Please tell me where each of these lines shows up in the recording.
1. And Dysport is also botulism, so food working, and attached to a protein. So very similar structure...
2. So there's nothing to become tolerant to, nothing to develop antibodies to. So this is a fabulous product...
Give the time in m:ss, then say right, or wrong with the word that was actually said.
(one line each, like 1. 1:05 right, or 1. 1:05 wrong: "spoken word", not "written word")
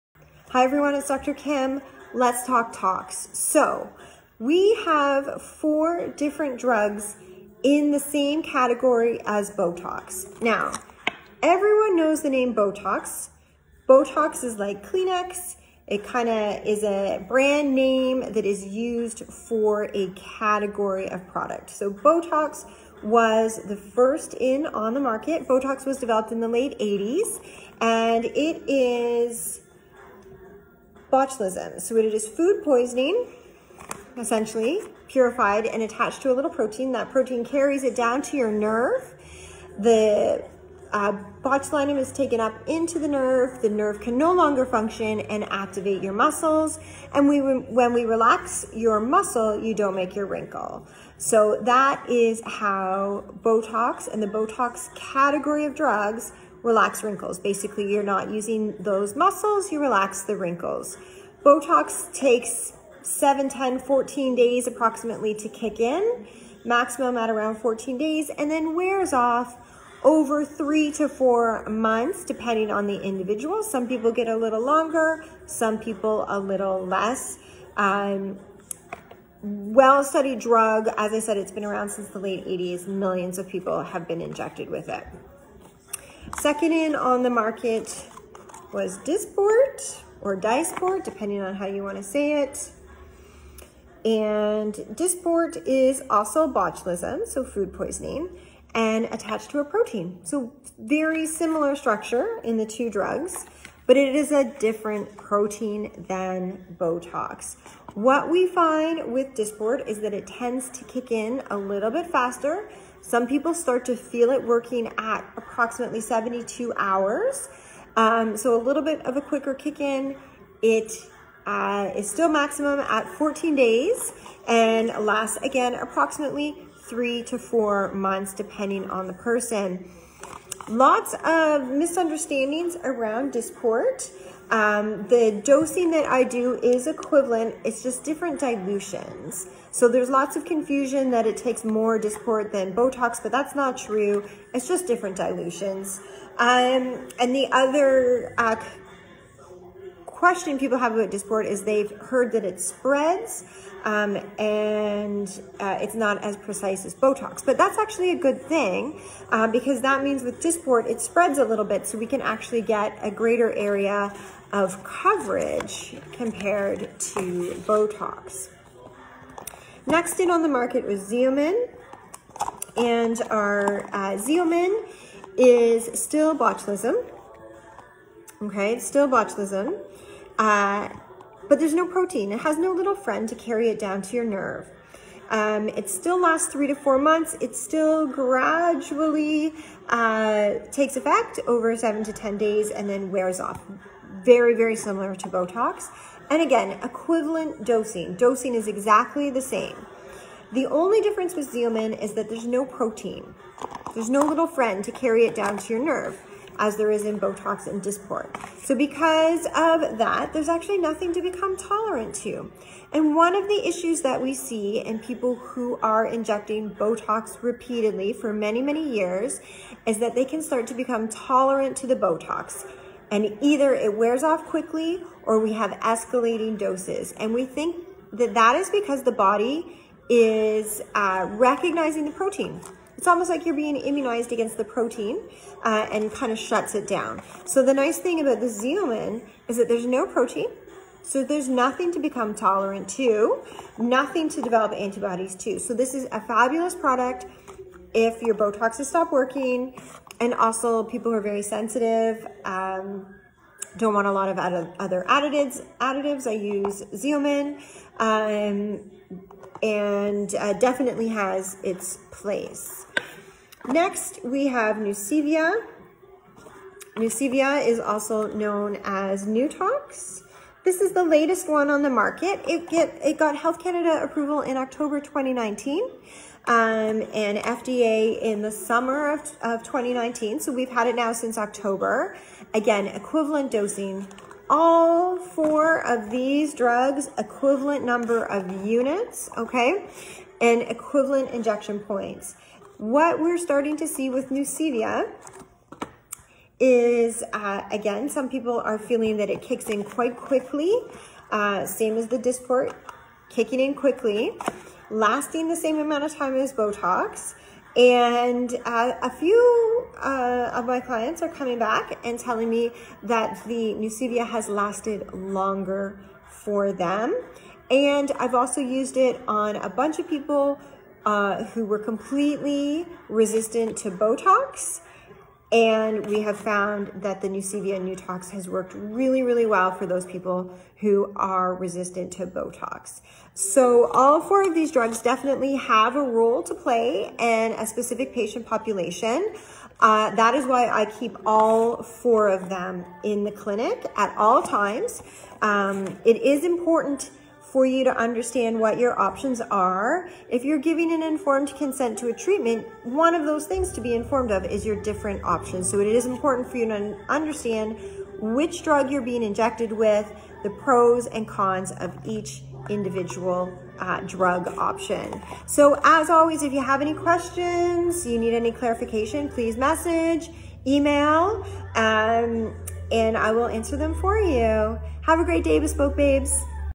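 1. 1:34 wrong: "poisoning", not "working"
2. 4:01 right.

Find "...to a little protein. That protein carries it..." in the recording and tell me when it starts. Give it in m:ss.
0:36.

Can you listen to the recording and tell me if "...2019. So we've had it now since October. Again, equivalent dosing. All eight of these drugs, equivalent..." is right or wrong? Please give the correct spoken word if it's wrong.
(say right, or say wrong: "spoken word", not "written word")
wrong: "four", not "eight".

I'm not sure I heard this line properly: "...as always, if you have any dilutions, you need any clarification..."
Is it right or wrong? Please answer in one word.
wrong.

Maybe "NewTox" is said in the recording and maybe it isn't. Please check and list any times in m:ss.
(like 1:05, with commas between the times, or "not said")
4:29, 5:27.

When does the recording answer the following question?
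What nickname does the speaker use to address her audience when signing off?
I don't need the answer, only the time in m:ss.
6:15.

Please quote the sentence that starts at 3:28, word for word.
So because of that, there's actually nothing to become tolerant to.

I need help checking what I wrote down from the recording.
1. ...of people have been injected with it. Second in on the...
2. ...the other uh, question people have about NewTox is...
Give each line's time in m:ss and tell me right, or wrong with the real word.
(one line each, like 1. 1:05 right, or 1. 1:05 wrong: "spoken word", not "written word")
1. 1:23 right
2. 2:27 wrong: "Dysport", not "NewTox".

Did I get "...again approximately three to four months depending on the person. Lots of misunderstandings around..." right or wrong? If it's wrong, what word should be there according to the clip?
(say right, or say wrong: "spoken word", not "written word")
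right.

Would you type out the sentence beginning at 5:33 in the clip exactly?
So all four of these drugs definitely have a role to play in a specific patient population.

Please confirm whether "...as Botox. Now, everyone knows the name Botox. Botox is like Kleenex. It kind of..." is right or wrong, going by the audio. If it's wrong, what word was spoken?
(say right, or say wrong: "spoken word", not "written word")
right.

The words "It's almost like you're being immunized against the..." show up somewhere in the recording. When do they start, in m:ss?
3:53.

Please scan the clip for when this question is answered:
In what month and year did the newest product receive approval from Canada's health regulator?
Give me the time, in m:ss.
4:34.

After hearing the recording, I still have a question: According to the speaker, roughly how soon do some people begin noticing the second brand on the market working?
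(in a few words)
72 hours.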